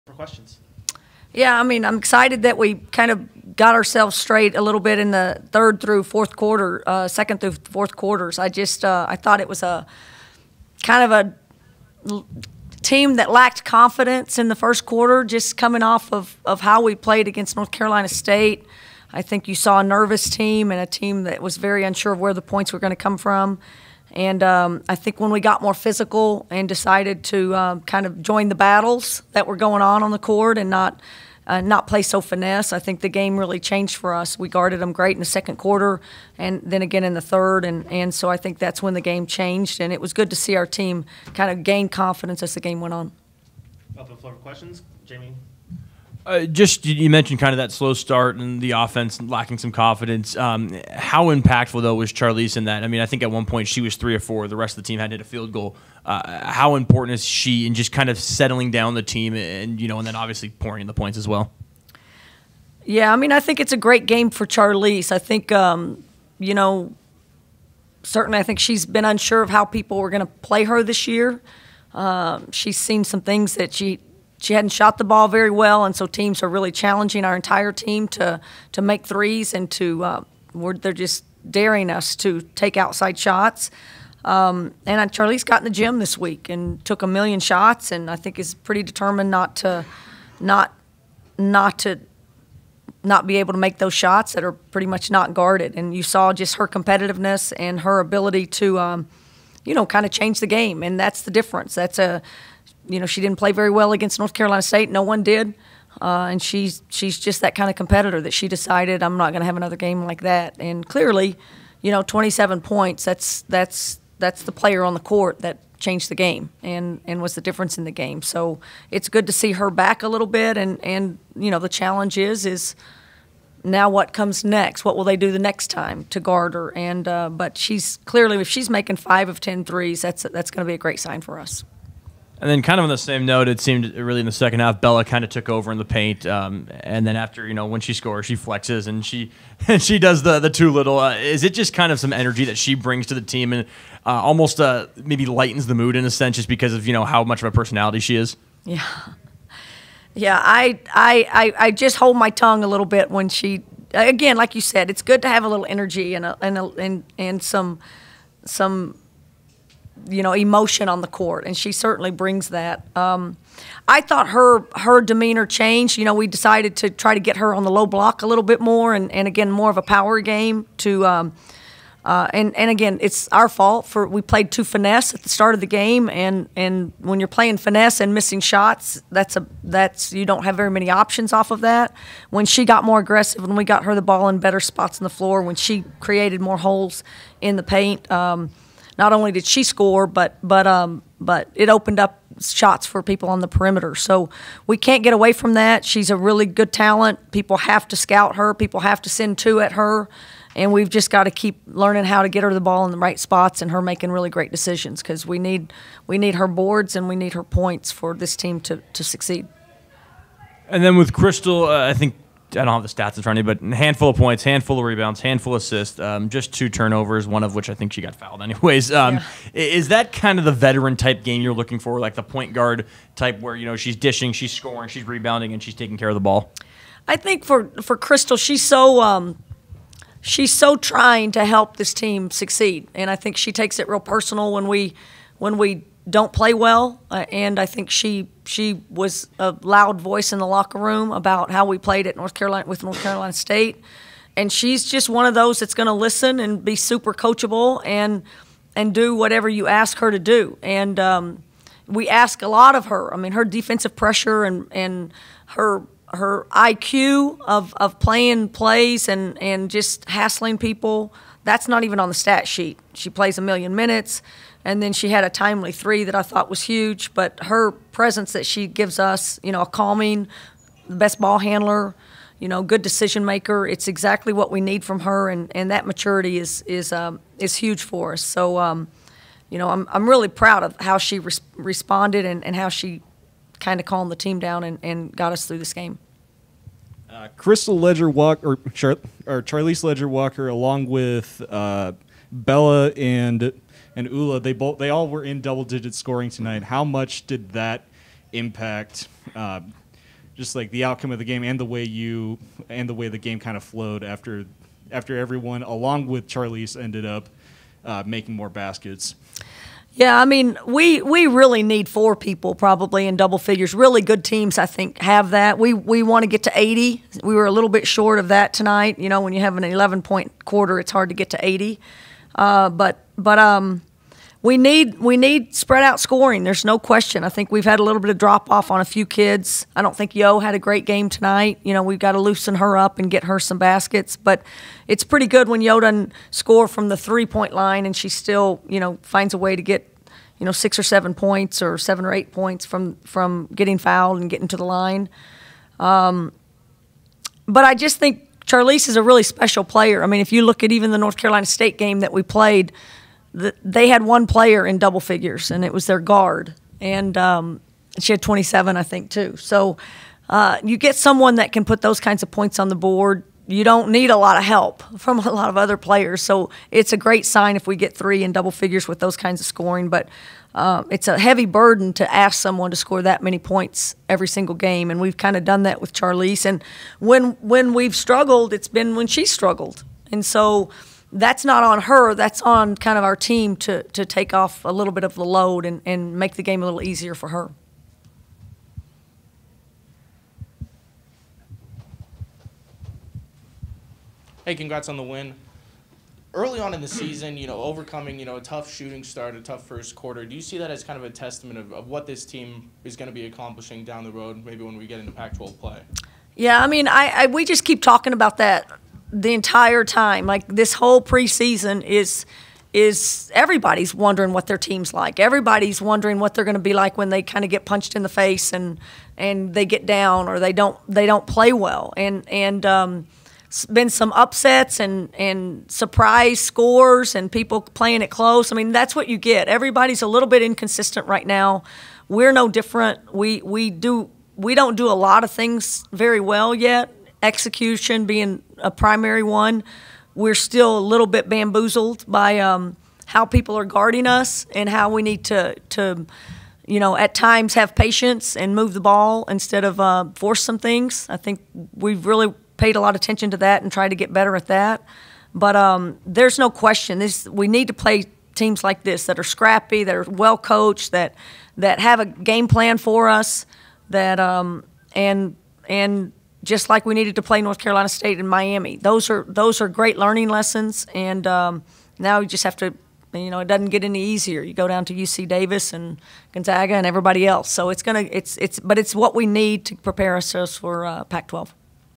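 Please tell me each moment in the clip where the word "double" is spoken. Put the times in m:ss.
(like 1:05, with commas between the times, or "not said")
4:55, 5:13, 5:54, 6:08.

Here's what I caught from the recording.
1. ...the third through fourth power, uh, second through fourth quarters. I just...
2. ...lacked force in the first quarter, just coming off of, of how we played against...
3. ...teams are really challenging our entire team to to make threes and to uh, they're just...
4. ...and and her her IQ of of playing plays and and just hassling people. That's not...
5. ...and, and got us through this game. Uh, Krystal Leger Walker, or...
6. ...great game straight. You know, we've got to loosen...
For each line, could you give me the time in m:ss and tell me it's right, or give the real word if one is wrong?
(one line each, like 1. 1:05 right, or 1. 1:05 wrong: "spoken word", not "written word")
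1. 0:05 wrong: "quarter", not "power"
2. 0:13 wrong: "confidence", not "force"
3. 1:16 right
4. 4:14 right
5. 4:44 right
6. 5:30 wrong: "tonight", not "straight".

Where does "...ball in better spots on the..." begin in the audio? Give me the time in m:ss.
3:04.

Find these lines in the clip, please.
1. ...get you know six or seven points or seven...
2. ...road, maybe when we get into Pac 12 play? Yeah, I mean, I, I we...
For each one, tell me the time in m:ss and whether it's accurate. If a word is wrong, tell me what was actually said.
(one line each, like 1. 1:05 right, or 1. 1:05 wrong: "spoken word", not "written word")
1. 5:39 right
2. 6:44 right.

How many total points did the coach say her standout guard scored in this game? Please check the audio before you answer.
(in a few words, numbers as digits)
27.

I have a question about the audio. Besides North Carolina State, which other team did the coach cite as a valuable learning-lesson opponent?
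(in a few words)
Miami.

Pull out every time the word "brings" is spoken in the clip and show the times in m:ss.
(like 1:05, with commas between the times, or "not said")
2:22, 2:42.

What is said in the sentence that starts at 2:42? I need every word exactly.
Um, I thought her her demeanor changed.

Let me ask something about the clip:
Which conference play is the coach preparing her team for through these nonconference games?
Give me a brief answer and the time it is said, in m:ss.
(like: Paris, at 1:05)
Pac-12, at 8:01.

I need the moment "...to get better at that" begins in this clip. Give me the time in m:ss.
7:33.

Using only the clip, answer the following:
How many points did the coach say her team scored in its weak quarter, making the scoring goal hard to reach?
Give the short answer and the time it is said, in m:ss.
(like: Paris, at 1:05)
11, at 5:19.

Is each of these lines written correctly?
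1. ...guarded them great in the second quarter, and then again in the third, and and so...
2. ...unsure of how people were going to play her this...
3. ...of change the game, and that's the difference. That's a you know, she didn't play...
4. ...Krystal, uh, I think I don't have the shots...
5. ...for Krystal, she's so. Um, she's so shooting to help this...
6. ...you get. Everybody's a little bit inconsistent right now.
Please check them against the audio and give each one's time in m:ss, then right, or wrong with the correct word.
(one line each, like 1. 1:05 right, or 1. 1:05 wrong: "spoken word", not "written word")
1. 0:34 right
2. 1:09 right
3. 1:40 right
4. 3:31 wrong: "stats", not "shots"
5. 3:47 wrong: "trying", not "shooting"
6. 7:09 right.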